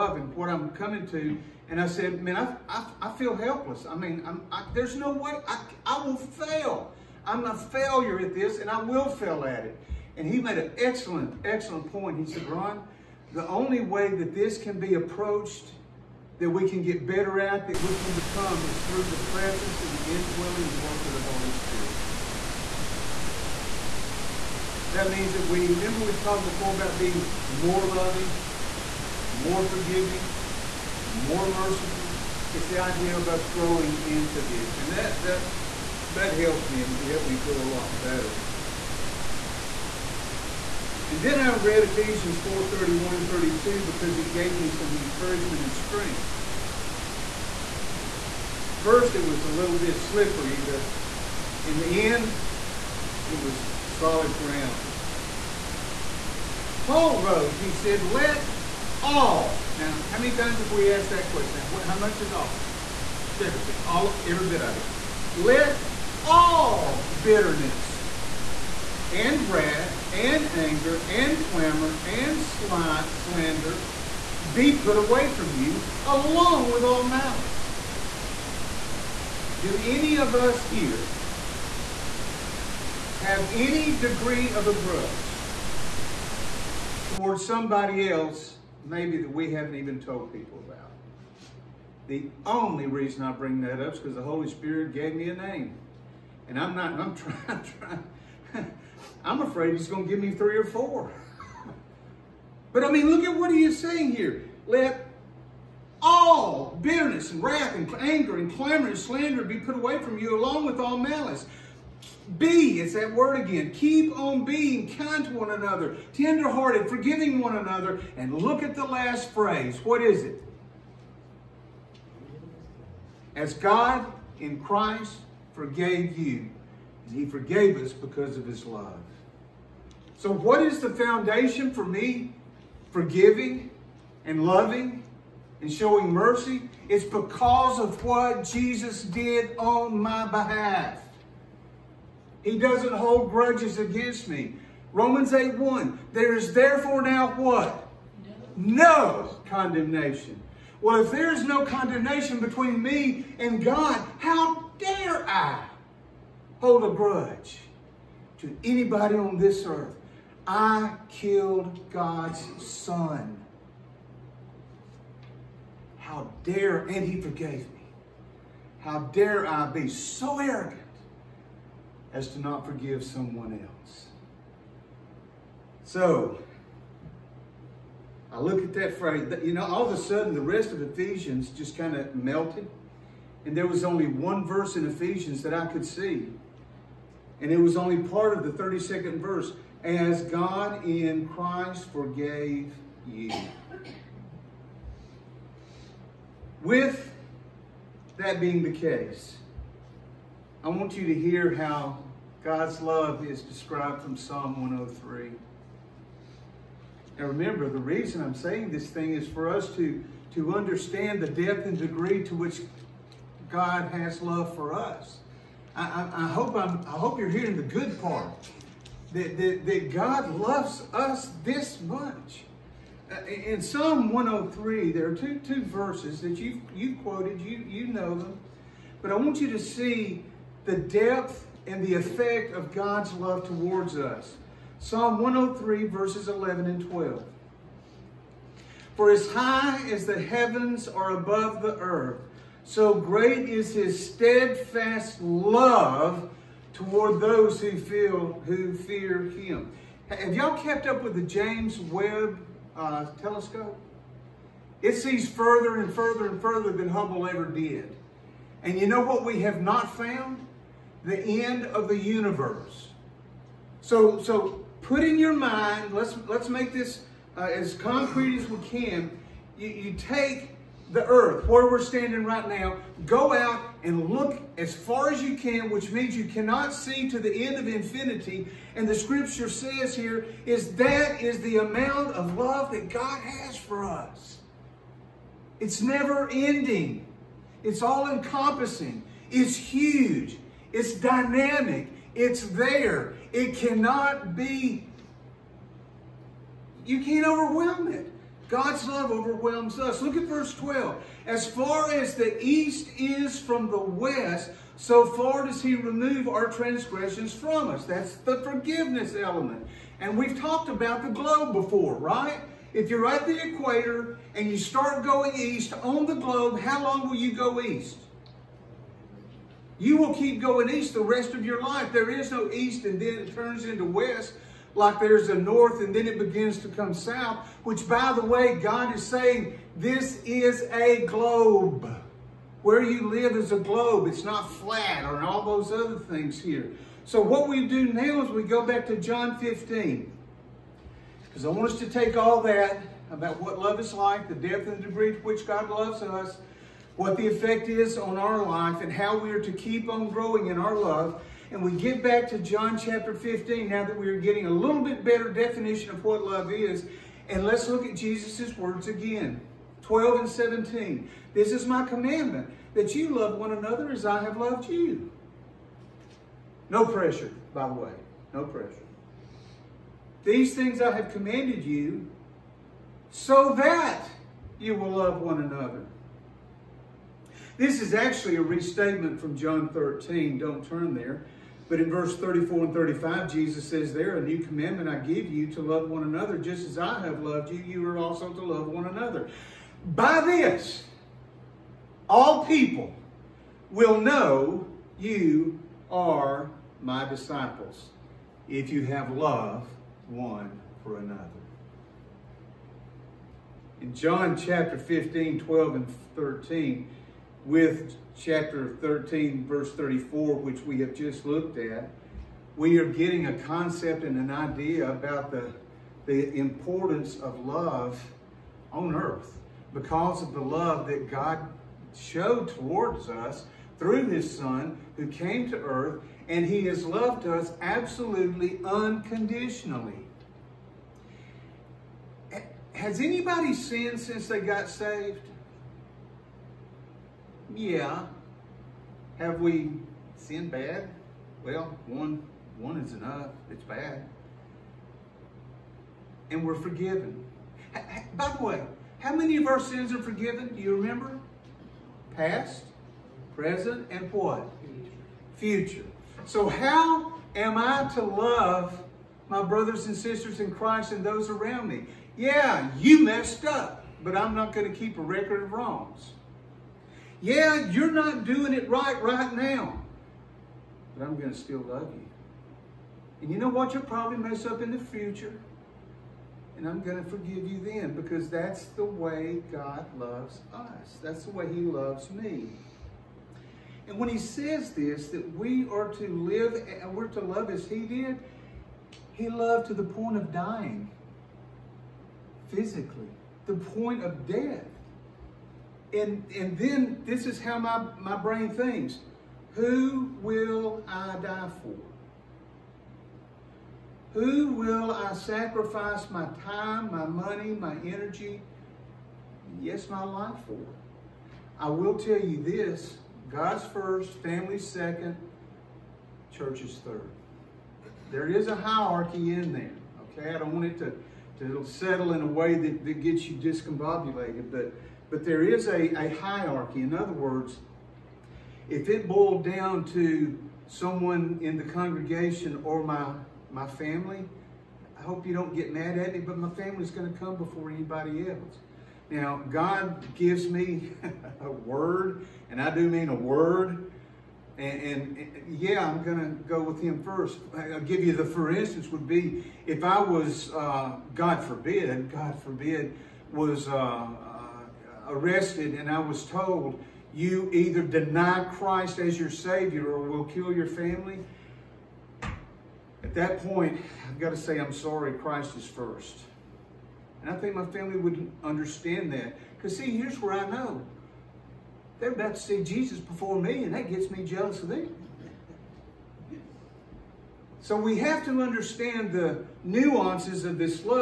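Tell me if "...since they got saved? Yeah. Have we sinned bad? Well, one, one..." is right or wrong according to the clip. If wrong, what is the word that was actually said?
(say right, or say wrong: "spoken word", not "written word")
right.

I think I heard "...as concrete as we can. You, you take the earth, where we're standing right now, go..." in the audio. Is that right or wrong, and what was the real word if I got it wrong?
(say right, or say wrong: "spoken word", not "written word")
right.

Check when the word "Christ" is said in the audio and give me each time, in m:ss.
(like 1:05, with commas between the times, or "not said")
2:04, 3:11, 7:40, 9:18, 9:25.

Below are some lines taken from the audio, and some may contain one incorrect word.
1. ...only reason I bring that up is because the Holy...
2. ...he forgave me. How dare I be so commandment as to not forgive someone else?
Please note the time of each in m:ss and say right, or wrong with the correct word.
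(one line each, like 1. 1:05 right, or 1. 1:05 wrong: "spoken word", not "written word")
1. 1:32 right
2. 2:47 wrong: "arrogant", not "commandment".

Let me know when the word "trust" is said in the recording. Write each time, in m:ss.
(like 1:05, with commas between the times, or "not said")
not said.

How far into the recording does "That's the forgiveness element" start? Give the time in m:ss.
5:07.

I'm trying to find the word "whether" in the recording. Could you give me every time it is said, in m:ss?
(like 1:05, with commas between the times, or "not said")
not said.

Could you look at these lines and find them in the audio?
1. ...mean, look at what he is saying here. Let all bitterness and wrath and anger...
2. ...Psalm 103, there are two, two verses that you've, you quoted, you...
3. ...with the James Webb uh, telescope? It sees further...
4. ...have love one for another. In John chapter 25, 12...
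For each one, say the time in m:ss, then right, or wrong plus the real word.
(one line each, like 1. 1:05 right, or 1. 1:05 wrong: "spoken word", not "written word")
1. 1:42 right
2. 3:43 right
3. 4:11 right
4. 6:38 wrong: "15", not "25".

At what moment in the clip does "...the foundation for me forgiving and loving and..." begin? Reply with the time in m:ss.
2:10.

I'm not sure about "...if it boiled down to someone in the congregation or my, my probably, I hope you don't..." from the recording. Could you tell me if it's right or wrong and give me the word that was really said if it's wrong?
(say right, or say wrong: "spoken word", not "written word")
wrong: "family", not "probably".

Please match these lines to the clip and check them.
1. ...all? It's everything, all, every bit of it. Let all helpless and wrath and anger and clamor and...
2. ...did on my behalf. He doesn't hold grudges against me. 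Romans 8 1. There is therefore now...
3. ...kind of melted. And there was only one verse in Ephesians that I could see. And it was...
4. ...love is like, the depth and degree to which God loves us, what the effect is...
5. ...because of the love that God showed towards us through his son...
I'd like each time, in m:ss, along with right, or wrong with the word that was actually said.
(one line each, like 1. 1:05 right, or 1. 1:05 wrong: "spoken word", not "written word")
1. 1:02 wrong: "bitterness", not "helpless"
2. 2:19 right
3. 3:01 right
4. 5:43 right
5. 6:59 right.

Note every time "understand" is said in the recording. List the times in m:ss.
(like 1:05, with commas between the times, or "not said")
3:30, 9:28, 9:38.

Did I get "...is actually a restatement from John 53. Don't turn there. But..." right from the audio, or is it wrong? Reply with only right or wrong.
wrong.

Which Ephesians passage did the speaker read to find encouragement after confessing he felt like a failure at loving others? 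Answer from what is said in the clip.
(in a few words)
Ephesians 4:31-32.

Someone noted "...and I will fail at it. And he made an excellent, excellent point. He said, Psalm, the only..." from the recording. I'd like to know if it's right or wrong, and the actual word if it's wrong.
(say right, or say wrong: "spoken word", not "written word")
wrong: "Ron", not "Psalm".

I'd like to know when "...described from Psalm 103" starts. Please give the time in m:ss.
3:23.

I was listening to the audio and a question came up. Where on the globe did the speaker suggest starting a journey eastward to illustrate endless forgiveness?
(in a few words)
The equator.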